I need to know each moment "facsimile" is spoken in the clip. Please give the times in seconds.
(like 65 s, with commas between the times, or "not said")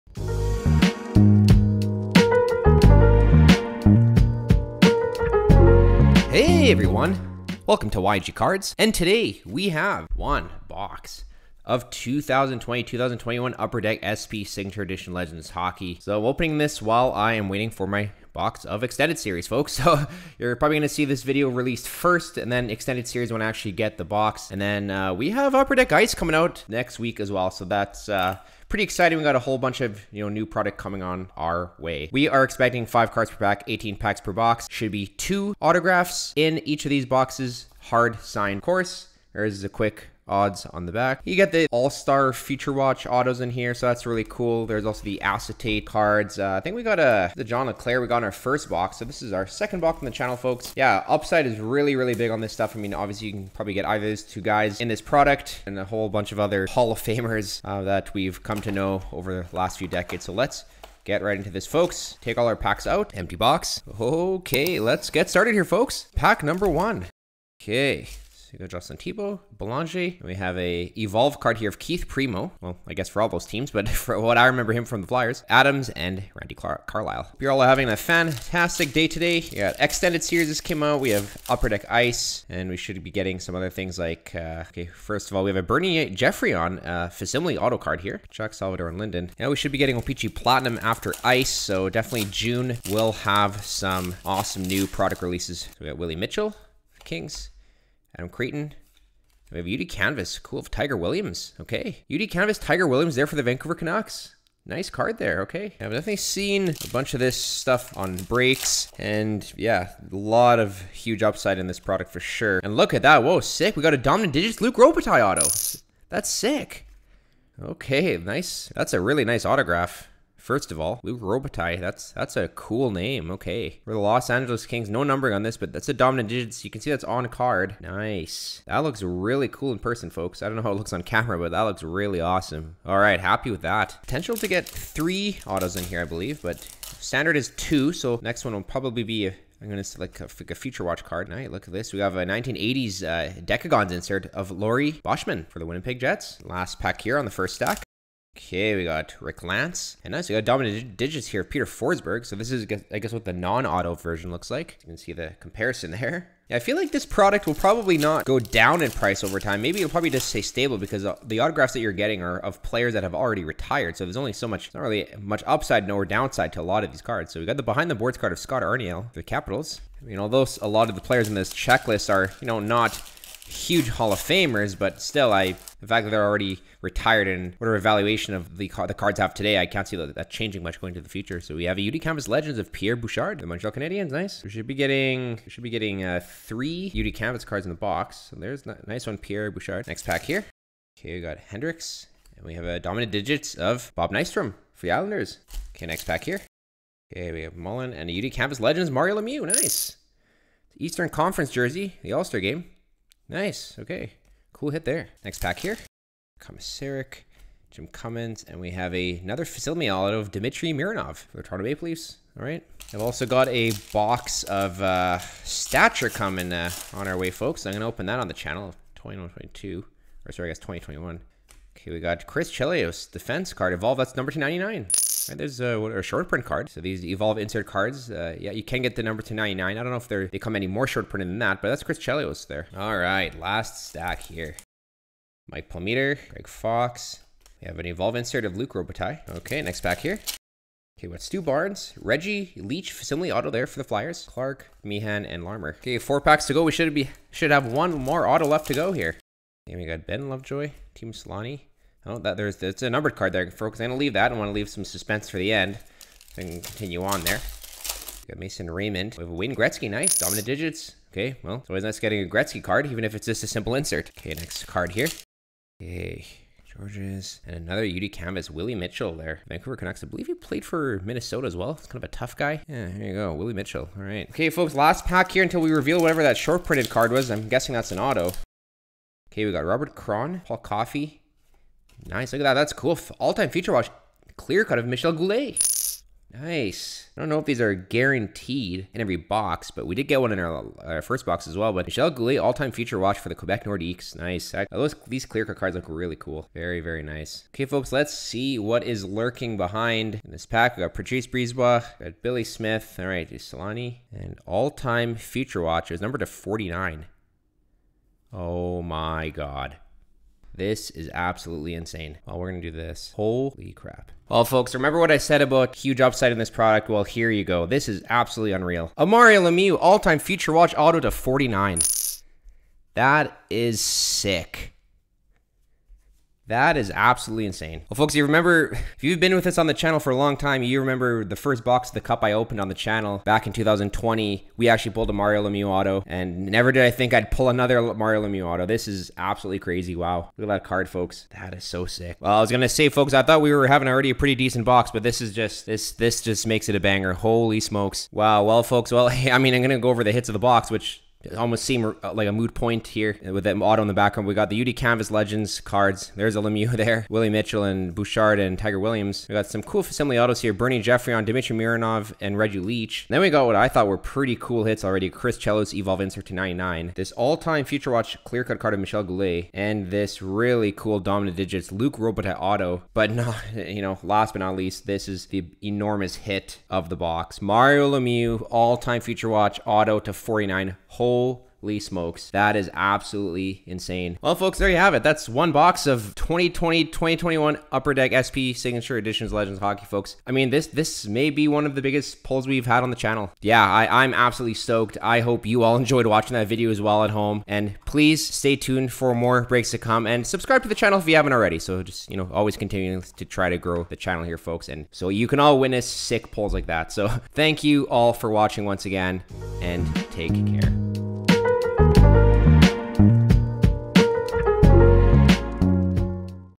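87 s, 242 s.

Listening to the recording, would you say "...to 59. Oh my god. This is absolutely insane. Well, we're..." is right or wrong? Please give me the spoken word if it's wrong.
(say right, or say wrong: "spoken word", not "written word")
wrong: "49", not "59".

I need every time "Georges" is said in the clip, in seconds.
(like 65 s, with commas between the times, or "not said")
266 s.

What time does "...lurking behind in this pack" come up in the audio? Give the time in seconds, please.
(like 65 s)
299 s.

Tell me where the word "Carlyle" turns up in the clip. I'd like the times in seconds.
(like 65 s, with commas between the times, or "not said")
76 s.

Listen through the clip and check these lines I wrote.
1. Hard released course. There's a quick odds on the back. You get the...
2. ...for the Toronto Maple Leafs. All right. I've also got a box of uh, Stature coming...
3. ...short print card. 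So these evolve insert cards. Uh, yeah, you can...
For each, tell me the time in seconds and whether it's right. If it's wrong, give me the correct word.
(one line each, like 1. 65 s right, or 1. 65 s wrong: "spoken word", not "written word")
1. 37 s wrong: "signed", not "released"
2. 211 s right
3. 226 s right.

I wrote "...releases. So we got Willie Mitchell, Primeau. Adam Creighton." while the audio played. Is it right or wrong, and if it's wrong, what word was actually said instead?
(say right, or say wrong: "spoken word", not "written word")
wrong: "Kings", not "Primeau".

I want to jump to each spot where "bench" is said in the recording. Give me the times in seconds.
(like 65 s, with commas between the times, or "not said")
not said.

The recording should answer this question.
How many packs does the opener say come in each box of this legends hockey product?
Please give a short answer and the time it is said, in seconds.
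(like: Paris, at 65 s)
18, at 33 s.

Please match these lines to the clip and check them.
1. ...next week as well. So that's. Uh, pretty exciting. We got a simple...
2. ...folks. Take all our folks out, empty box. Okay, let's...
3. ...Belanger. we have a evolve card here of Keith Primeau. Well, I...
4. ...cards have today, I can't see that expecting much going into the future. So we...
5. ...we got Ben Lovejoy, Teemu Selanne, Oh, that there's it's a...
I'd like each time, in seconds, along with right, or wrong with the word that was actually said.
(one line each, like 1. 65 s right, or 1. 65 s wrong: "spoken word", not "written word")
1. 26 s wrong: "whole", not "simple"
2. 61 s wrong: "packs", not "folks"
3. 69 s right
4. 178 s wrong: "changing", not "expecting"
5. 249 s right.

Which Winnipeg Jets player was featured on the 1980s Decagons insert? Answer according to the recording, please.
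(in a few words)
Laurie Boschman.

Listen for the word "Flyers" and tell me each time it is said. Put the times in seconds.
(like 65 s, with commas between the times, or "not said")
75 s, 243 s.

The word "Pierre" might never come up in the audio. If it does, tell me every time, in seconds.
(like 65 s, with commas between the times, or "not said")
182 s, 189 s.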